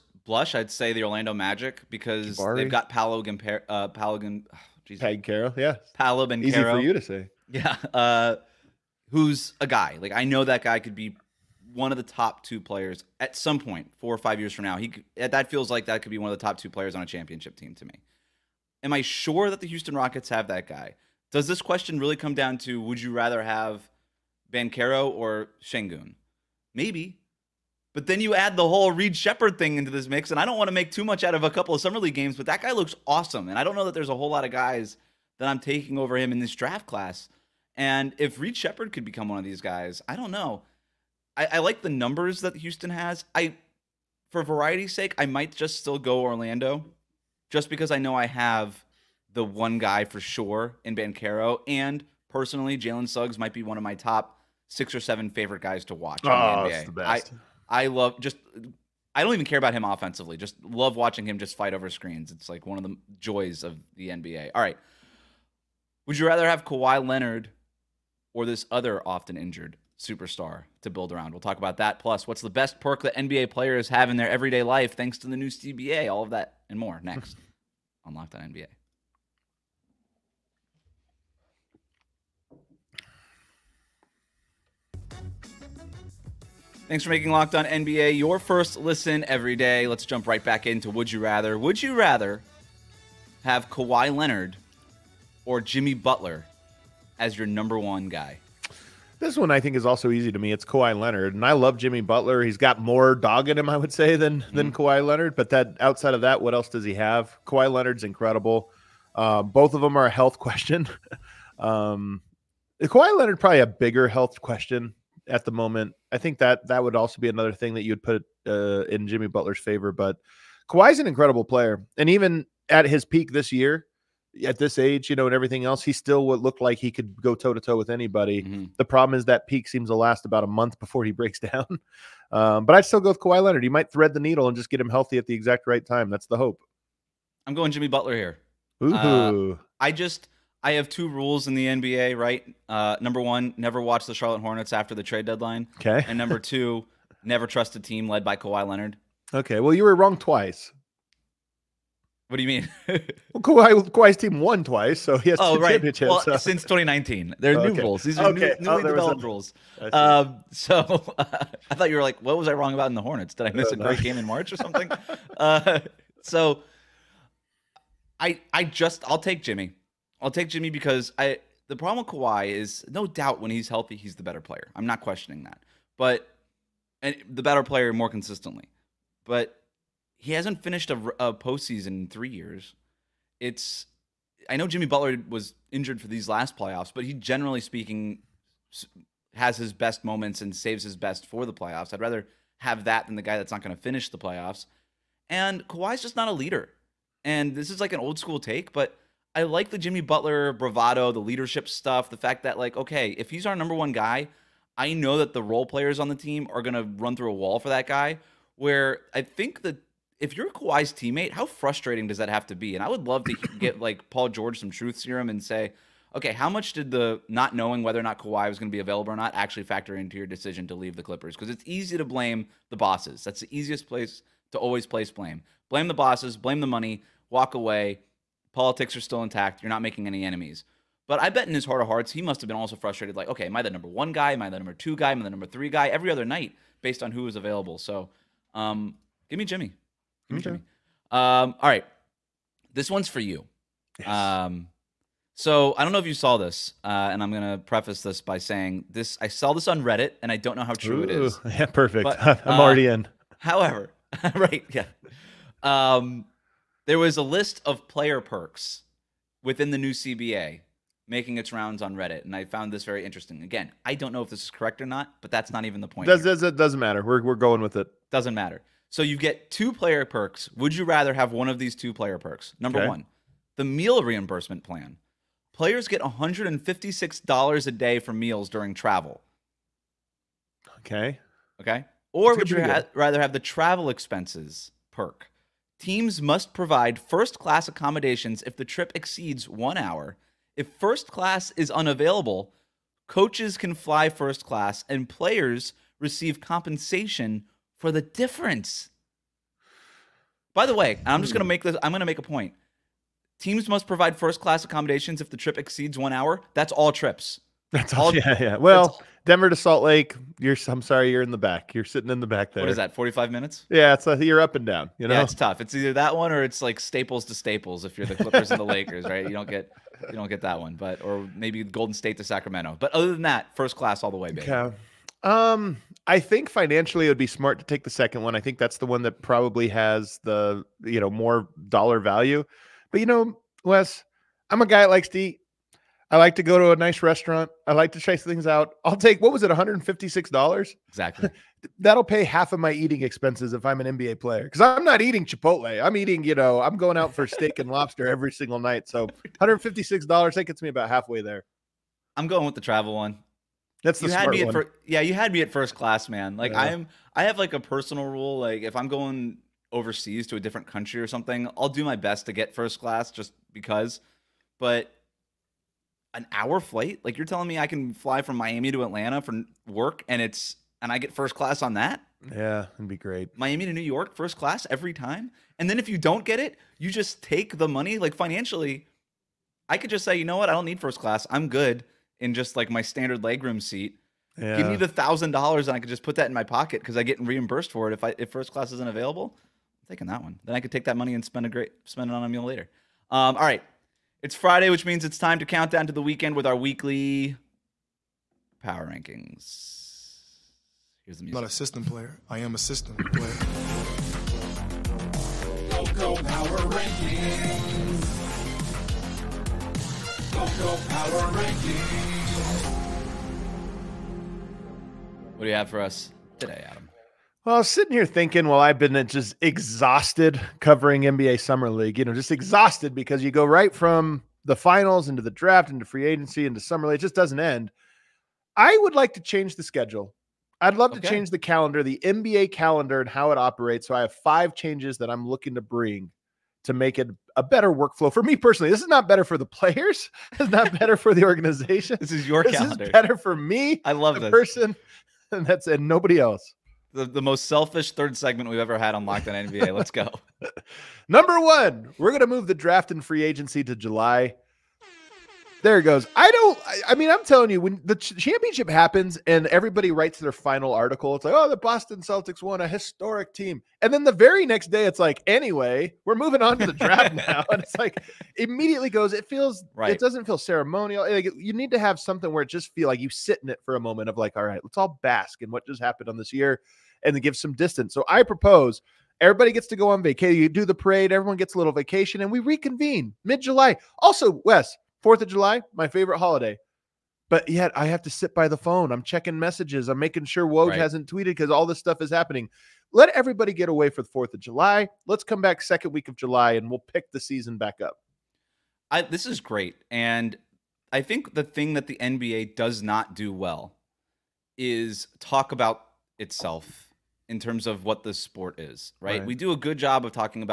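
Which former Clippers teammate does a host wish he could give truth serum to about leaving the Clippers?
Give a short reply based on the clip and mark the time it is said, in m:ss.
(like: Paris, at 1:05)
Paul George, at 3:34.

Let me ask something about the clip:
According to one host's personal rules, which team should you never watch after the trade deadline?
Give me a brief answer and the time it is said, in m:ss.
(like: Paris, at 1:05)
Charlotte Hornets, at 2:24.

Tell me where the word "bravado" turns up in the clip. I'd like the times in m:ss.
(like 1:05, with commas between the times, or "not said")
3:20.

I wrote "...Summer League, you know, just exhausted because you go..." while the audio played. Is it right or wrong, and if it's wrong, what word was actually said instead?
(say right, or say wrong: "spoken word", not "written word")
right.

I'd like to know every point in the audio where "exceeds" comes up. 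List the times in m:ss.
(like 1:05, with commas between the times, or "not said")
4:48, 5:05.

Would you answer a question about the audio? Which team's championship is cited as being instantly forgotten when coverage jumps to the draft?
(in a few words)
Boston Celtics.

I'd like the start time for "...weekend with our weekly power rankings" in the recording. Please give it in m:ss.
6:36.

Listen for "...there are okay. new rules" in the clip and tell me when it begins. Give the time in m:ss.
2:37.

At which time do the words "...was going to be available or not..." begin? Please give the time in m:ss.
3:38.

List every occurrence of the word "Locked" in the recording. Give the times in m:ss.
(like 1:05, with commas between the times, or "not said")
1:18, 1:27, 7:29.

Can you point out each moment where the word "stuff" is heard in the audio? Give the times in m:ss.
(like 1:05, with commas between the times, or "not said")
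3:21, 8:11.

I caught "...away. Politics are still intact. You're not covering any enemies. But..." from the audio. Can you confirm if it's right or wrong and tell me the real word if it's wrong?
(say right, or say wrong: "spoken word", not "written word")
wrong: "making", not "covering".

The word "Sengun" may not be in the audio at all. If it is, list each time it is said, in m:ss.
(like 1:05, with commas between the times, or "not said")
0:25.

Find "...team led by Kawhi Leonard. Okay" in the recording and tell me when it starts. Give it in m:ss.
2:27.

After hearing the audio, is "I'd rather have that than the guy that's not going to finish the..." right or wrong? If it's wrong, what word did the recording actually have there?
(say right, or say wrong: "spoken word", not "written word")
right.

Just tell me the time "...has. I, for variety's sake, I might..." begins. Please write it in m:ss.
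0:42.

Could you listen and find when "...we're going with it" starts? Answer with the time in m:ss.
4:27.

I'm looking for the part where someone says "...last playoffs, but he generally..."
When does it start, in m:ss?
3:06.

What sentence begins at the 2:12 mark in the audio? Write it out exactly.
Um, but I'd still go with Kawhi Leonard.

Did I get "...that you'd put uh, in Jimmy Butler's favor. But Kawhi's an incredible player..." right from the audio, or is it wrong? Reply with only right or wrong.
right.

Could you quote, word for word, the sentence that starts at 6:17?
Like financially, I could just say, you know what, I don't need first class.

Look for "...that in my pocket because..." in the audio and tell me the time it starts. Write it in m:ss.
6:26.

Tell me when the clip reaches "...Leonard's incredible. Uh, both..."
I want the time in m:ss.
1:47.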